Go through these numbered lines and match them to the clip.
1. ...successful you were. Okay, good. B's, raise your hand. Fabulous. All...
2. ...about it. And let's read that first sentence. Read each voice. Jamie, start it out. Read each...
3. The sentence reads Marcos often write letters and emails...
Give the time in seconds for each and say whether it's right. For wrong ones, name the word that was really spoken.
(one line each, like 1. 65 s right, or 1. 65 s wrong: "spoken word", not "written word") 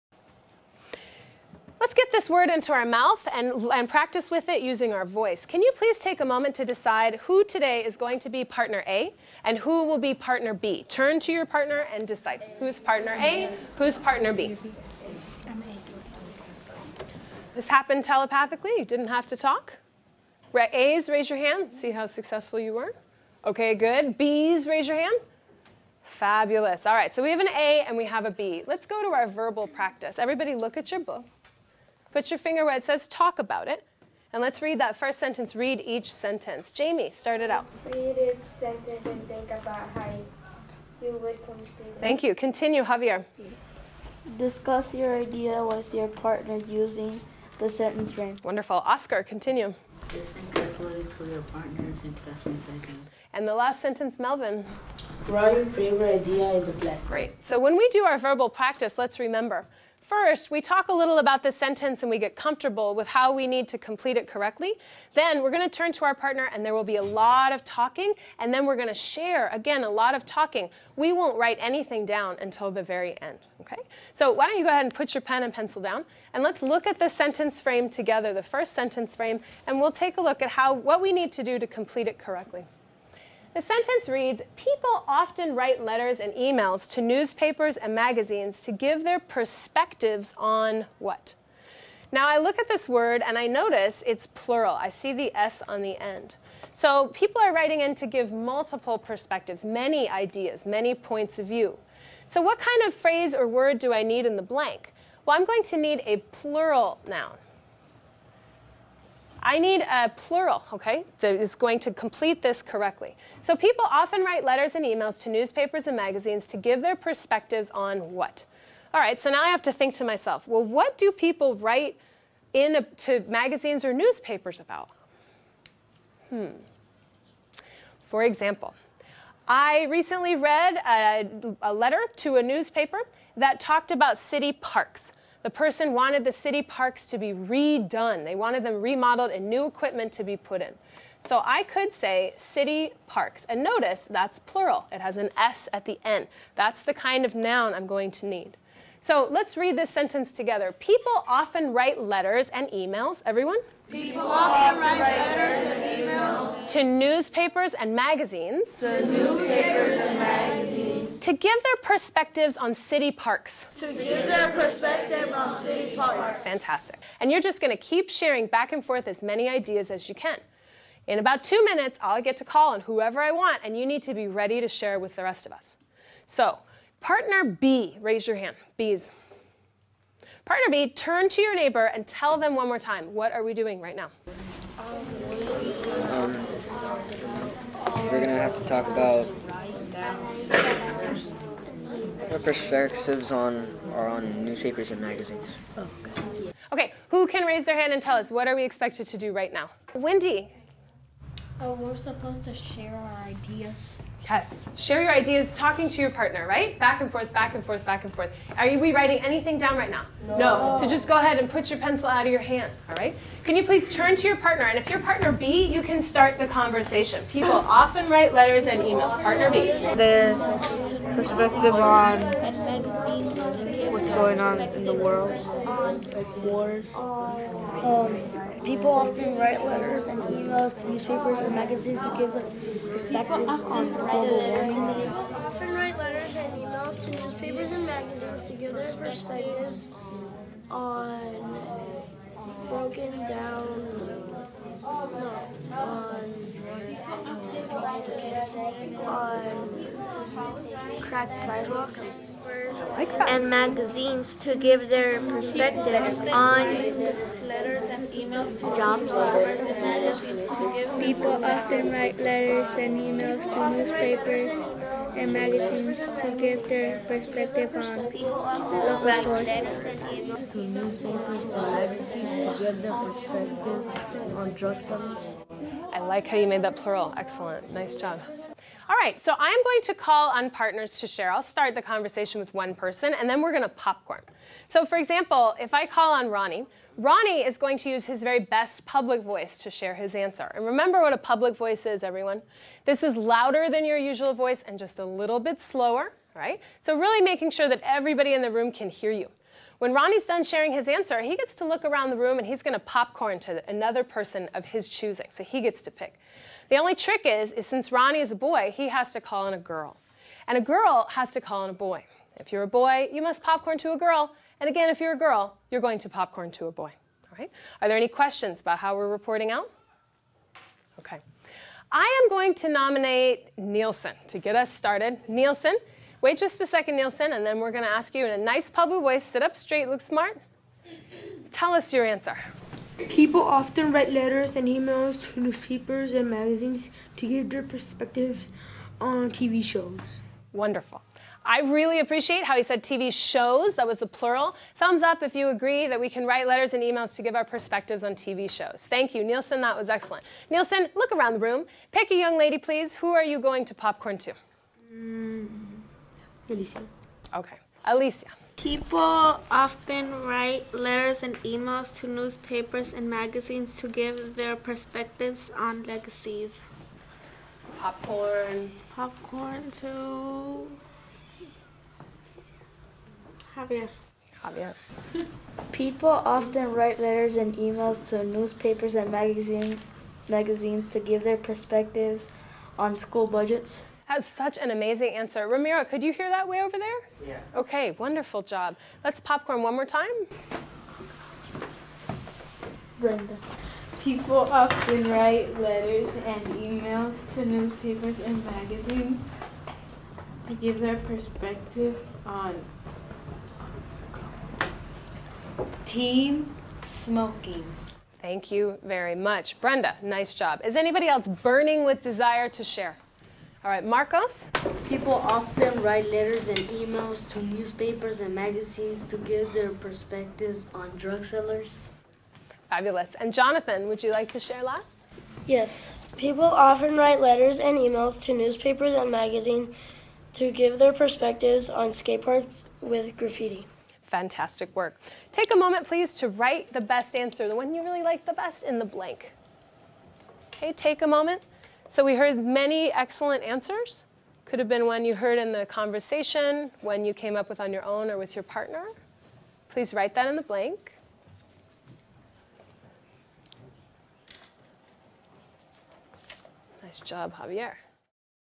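1. 22 s right
2. 33 s wrong: "sentence", not "voice"
3. 83 s wrong: "People", not "Marcos".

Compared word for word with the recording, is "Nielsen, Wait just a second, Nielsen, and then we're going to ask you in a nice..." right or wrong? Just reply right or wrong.
right.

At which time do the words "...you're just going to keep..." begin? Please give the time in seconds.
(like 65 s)
167 s.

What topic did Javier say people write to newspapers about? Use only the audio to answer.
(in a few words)
school budgets.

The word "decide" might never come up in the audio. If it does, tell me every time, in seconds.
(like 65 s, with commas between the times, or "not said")
6 s, 12 s.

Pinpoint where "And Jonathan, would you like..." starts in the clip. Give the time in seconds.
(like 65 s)
423 s.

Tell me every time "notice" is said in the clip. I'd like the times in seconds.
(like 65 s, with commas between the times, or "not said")
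93 s, 143 s.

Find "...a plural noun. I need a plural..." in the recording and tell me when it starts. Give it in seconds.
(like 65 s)
106 s.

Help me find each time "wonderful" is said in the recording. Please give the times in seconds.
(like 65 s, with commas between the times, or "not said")
48 s, 340 s, 387 s.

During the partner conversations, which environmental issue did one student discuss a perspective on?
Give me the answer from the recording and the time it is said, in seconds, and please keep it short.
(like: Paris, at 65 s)
global warming, at 233 s.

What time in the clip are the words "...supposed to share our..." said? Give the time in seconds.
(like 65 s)
201 s.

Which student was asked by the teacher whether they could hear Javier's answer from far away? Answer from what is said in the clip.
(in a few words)
Ramiro.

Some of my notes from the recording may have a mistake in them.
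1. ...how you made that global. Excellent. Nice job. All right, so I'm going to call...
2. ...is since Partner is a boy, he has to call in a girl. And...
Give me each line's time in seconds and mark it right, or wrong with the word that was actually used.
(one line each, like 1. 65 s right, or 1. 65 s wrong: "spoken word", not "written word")
1. 276 s wrong: "plural", not "global"
2. 307 s wrong: "Ronnie", not "Partner".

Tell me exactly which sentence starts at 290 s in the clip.
And remember what a public voice is, everyone.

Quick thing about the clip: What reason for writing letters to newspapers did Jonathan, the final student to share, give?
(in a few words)
parks with graffiti.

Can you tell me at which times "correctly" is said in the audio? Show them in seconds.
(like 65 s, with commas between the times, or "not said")
64 s, 82 s, 112 s.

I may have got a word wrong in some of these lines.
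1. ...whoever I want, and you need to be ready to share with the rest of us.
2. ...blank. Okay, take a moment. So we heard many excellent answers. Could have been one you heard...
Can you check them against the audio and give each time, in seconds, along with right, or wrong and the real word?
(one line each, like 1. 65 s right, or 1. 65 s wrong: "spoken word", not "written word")
1. 172 s right
2. 438 s right.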